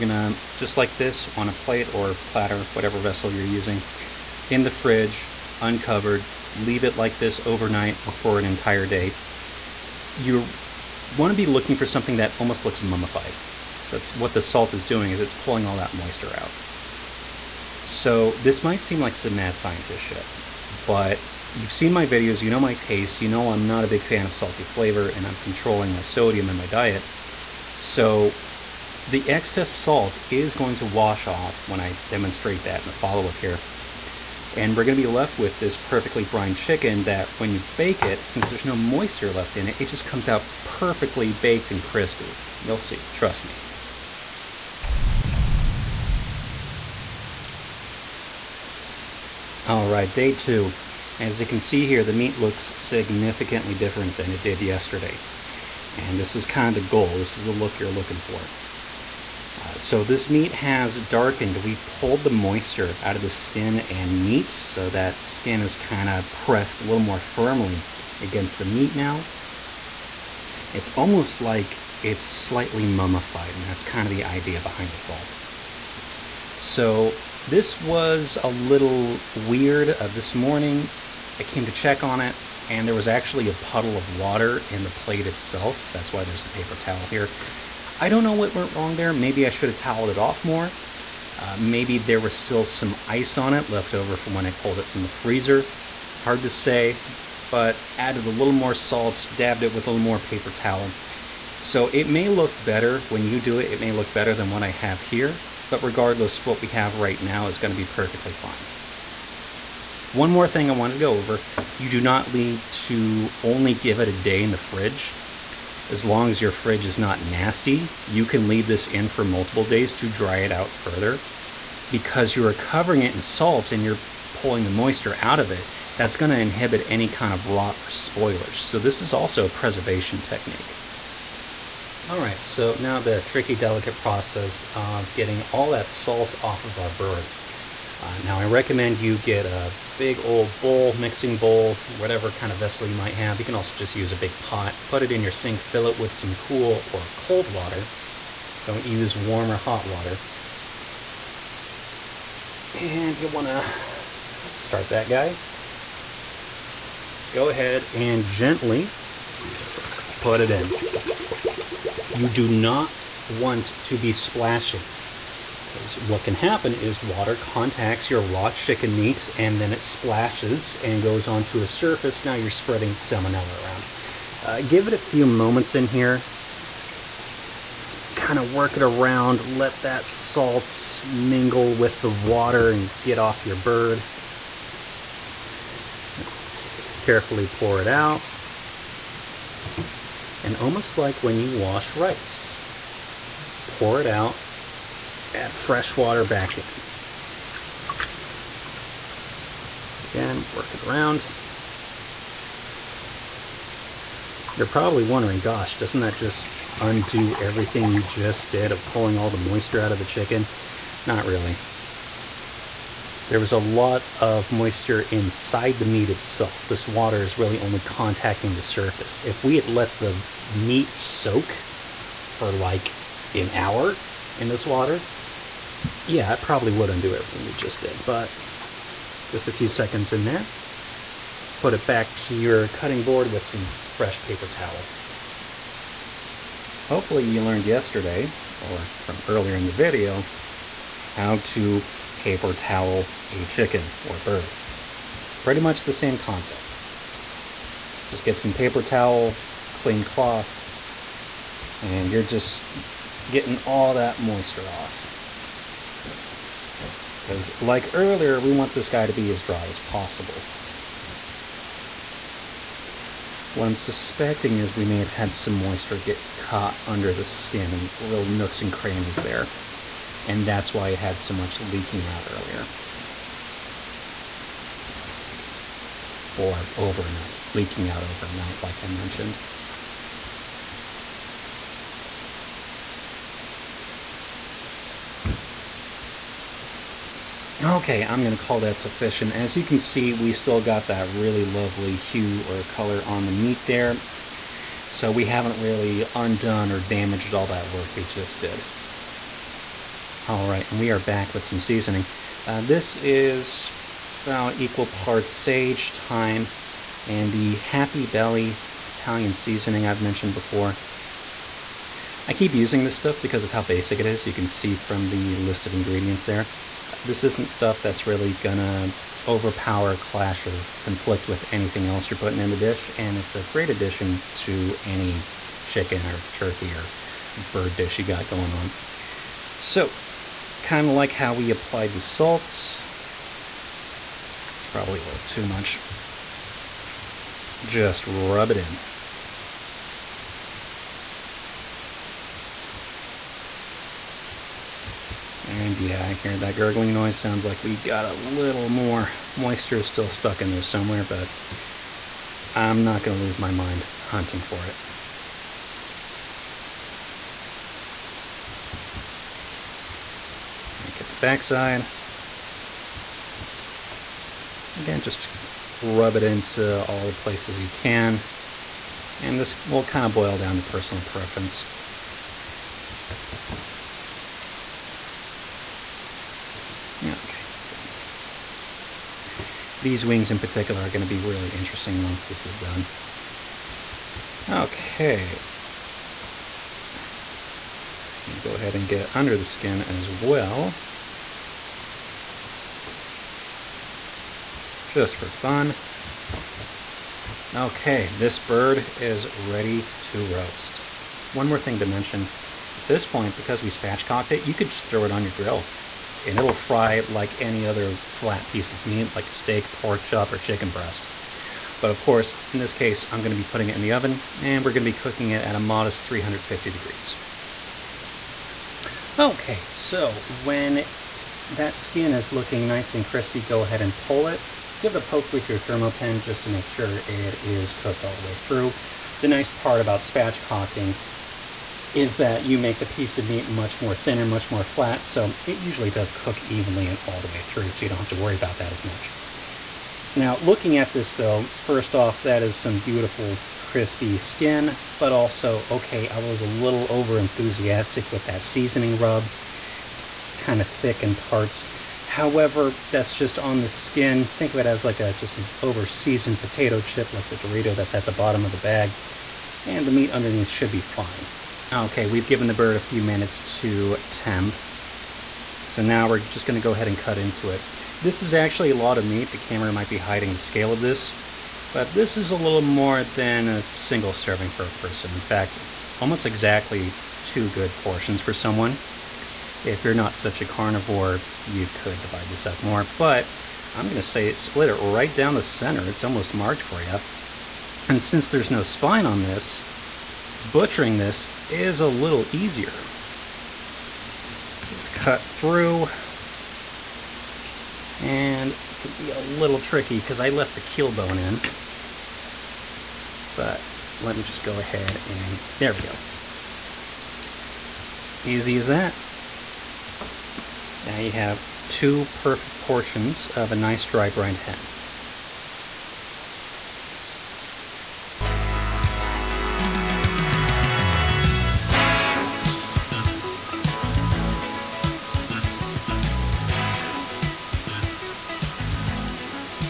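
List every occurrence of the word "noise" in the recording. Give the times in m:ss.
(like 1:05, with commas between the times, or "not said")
5:46.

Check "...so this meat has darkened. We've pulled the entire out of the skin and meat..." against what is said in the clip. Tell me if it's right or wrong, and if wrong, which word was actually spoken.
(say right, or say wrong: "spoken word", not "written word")
wrong: "moisture", not "entire".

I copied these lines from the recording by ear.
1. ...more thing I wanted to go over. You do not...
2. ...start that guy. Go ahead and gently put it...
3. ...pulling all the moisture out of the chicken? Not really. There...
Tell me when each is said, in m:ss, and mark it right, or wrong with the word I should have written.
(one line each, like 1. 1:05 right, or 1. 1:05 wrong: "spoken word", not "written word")
1. 1:50 right
2. 2:34 right
3. 3:28 right.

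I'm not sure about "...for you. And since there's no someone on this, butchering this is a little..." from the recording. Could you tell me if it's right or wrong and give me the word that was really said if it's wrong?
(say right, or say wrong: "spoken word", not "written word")
wrong: "spine", not "someone".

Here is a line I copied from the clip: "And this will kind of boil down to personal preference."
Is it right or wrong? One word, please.
right.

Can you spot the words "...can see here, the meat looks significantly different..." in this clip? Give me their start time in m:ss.
0:51.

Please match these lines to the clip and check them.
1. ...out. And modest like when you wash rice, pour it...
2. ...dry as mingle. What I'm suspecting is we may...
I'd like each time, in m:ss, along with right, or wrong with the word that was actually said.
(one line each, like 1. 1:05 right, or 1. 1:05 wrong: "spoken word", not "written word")
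1. 3:07 wrong: "almost", not "modest"
2. 4:19 wrong: "possible", not "mingle".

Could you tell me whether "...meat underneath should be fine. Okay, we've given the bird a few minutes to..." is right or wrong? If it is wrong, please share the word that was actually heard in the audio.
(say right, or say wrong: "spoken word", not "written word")
right.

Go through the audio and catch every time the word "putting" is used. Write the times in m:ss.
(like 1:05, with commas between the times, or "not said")
5:22, 6:53.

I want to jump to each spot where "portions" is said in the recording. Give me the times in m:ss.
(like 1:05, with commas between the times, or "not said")
7:57, 8:32.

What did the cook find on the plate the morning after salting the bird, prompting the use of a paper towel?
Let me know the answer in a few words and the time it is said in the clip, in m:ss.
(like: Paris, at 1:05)
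A puddle of water, at 1:23.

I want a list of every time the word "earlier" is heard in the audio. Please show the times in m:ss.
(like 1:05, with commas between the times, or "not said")
3:59, 4:17, 4:32.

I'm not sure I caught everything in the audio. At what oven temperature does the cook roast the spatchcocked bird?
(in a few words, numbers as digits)
350 degrees.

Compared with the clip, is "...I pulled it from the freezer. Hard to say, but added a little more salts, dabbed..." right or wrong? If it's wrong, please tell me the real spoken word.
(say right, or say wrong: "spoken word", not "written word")
right.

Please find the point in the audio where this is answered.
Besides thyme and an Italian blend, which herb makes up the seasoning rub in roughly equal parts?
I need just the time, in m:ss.
5:05.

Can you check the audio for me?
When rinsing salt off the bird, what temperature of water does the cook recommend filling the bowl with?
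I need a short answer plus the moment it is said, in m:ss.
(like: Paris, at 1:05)
Cool or cold, at 2:26.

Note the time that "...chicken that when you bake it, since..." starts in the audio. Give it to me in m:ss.
0:36.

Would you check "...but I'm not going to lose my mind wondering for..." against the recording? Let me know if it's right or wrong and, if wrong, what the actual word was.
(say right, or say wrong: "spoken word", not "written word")
wrong: "hunting", not "wondering".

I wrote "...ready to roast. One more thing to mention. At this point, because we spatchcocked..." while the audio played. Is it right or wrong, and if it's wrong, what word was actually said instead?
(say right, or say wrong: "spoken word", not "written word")
right.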